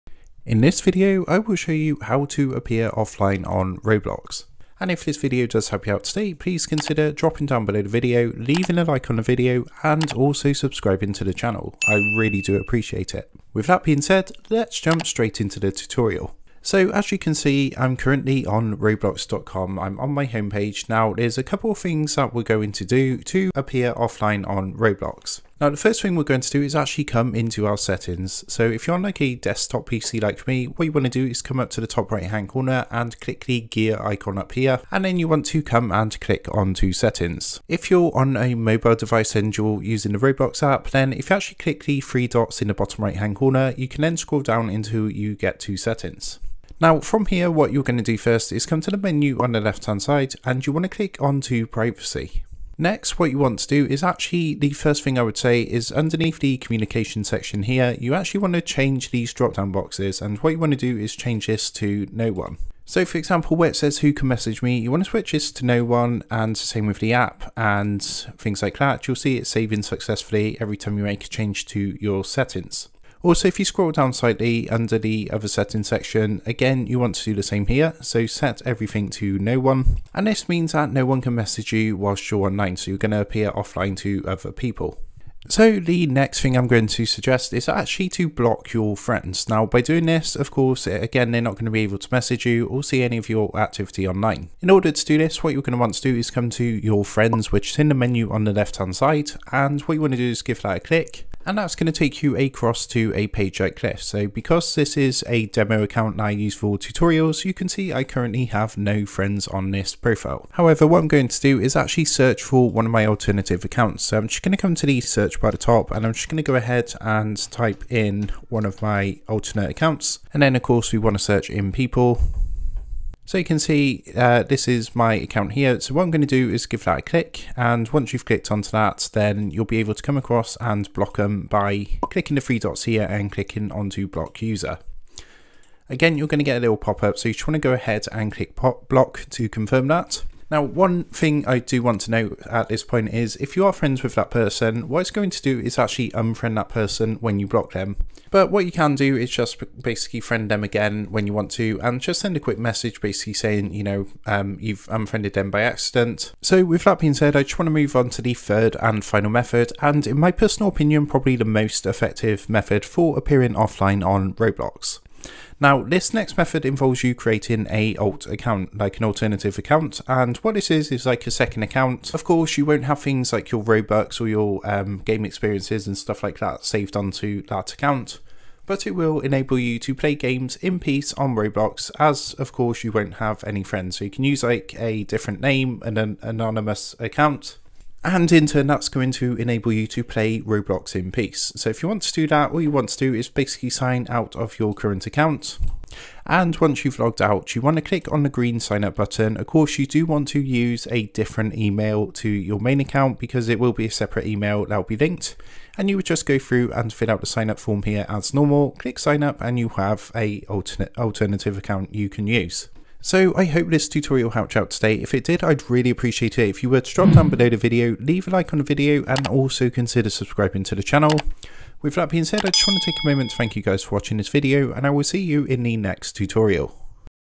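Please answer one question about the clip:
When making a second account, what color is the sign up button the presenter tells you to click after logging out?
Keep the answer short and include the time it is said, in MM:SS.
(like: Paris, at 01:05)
green, at 03:18.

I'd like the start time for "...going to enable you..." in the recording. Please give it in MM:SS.
03:08.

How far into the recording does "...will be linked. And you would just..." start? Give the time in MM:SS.
03:24.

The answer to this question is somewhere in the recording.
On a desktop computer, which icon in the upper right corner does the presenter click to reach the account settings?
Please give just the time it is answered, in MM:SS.
00:33.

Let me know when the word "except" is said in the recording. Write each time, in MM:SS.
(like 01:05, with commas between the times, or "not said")
not said.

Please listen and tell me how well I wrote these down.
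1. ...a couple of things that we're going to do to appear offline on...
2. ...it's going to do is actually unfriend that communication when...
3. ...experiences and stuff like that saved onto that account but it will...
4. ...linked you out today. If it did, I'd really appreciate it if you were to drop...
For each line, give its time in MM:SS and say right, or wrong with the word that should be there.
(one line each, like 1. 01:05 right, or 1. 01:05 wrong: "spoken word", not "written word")
1. 00:21 right
2. 02:24 wrong: "person", not "communication"
3. 02:55 right
4. 03:34 wrong: "helped", not "linked".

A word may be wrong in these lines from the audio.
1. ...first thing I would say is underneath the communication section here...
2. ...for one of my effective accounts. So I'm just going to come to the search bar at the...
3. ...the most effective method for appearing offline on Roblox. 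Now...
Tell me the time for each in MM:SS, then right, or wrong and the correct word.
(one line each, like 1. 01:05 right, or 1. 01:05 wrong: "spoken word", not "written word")
1. 00:54 right
2. 01:52 wrong: "alternative", not "effective"
3. 02:41 right.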